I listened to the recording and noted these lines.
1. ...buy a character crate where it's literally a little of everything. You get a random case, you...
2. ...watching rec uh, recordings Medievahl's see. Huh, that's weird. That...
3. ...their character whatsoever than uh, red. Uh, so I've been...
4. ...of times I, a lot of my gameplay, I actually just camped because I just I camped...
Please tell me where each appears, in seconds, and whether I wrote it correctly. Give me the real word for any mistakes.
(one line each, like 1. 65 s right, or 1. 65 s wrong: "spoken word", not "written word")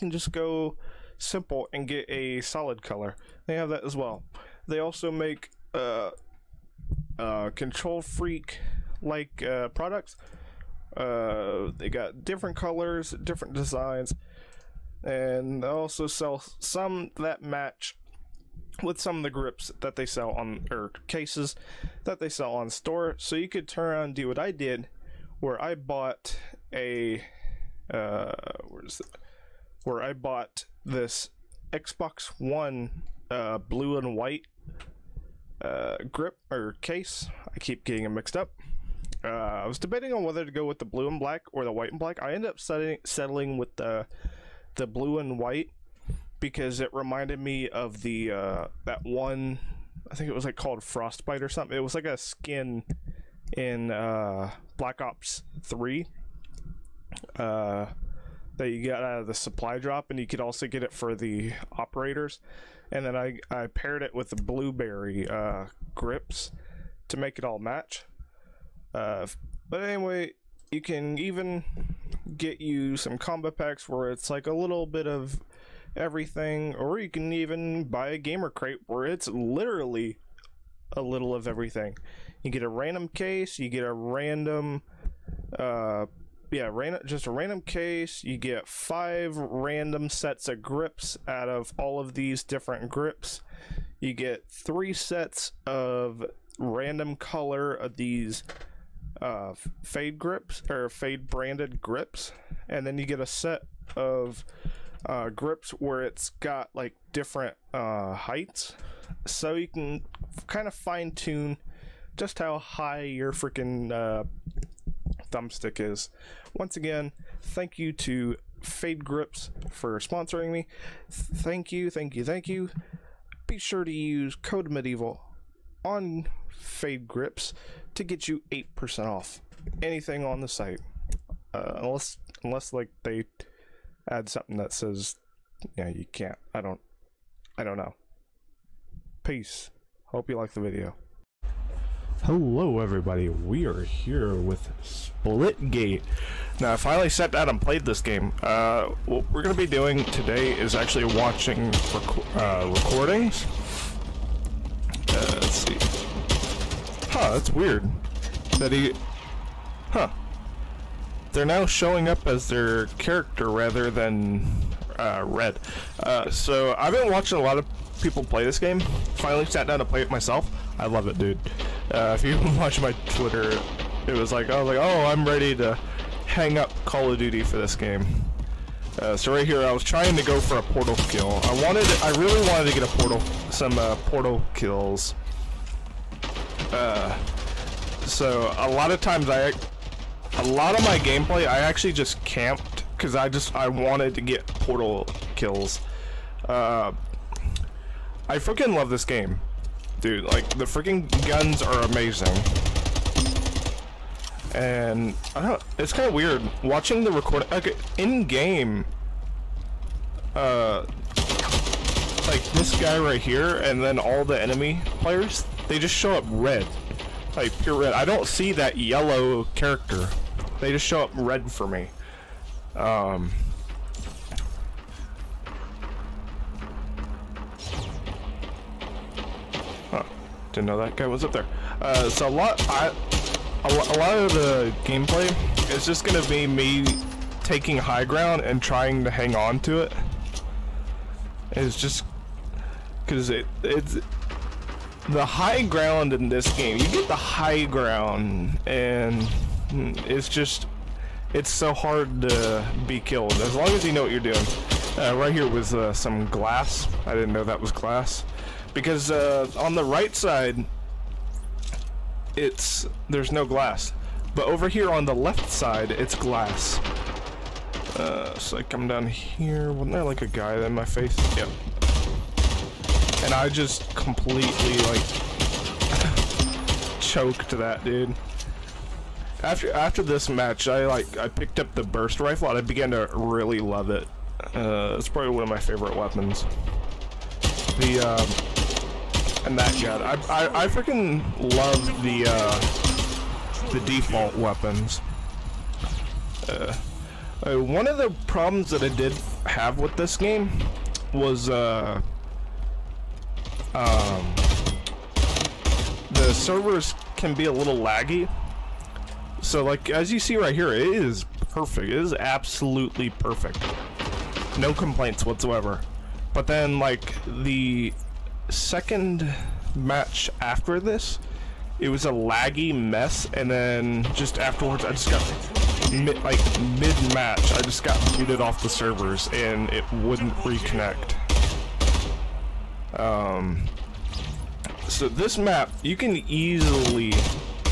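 1. 77 s wrong: "gamer", not "character"
2. 151 s wrong: "Let", not "Medievahl"
3. 162 s wrong: "rather", not "whatsoever"
4. 188 s wrong: "wanted", not "camped".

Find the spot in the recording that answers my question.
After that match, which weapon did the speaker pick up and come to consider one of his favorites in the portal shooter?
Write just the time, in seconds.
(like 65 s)
281 s.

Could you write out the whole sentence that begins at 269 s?
Wasn't there like a guy in my face?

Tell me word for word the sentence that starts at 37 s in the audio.
I keep getting them mixed up.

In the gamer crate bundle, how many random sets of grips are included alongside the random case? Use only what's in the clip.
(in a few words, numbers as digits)
5.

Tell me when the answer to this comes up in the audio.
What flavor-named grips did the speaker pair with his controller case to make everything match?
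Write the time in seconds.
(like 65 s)
64 s.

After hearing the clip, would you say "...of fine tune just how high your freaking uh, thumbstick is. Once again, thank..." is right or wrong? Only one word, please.
right.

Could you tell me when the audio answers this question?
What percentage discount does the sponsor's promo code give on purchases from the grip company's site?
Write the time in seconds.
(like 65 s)
128 s.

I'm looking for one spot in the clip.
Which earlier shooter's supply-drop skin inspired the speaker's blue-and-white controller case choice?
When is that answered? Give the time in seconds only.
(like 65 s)
54 s.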